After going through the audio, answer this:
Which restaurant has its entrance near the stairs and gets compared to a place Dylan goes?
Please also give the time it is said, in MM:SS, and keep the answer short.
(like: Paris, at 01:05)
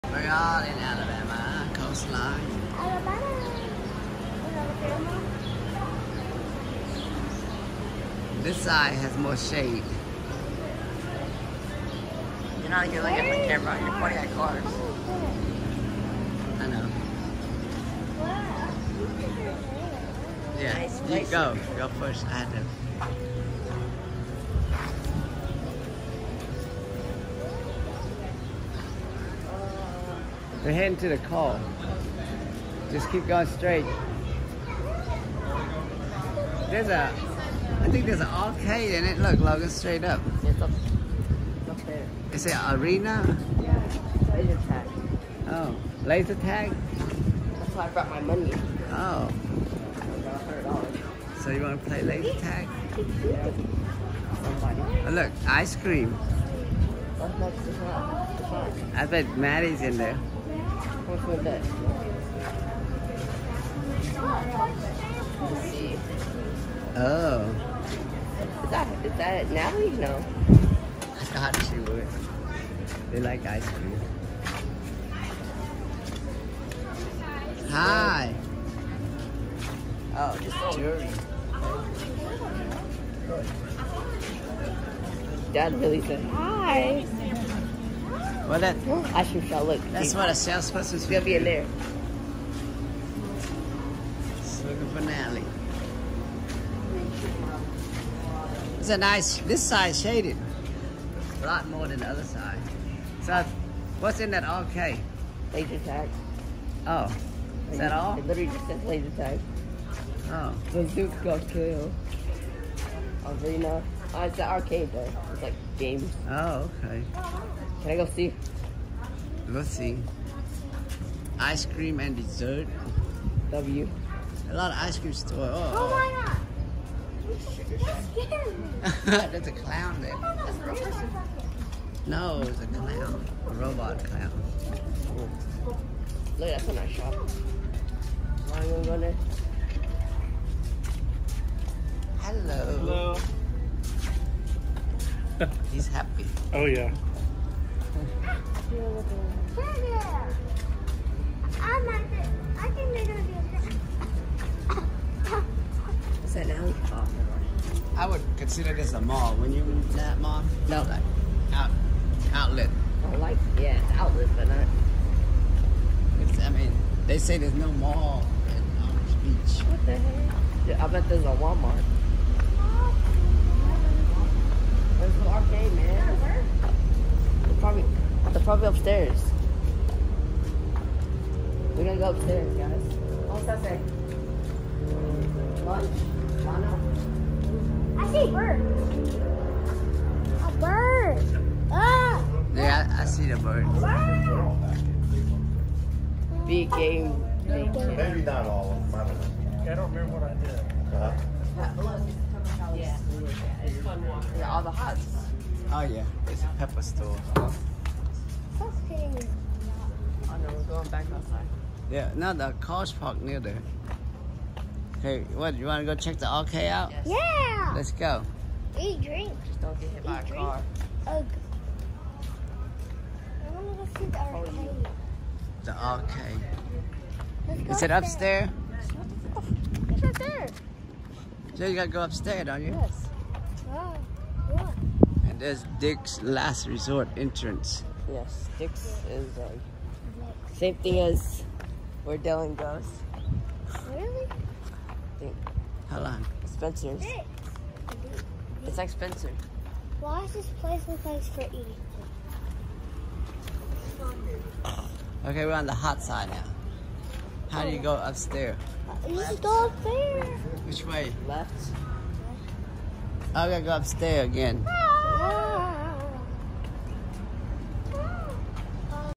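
Dick's Last Resort, at 03:55.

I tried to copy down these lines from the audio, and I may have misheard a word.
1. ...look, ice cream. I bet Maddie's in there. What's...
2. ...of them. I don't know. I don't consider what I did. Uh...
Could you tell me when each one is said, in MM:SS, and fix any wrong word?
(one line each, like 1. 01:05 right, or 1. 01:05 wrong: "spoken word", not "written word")
1. 00:55 right
2. 03:18 wrong: "remember", not "consider".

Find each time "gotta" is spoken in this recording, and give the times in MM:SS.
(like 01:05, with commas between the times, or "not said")
03:51, 04:23.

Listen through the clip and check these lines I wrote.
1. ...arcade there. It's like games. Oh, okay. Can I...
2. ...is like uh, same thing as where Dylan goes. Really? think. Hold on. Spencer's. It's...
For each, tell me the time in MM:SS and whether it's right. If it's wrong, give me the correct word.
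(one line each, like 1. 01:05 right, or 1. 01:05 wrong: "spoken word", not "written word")
1. 01:54 right
2. 03:59 right.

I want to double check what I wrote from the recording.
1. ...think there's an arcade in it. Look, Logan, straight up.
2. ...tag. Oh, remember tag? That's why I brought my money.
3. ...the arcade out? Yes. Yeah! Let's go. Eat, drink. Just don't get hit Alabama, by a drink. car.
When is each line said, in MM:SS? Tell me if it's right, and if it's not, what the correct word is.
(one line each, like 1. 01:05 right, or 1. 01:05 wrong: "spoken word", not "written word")
1. 00:37 right
2. 00:44 wrong: "laser", not "remember"
3. 03:36 wrong: "Eat", not "Alabama".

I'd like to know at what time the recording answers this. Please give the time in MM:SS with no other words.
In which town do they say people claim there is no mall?
02:48.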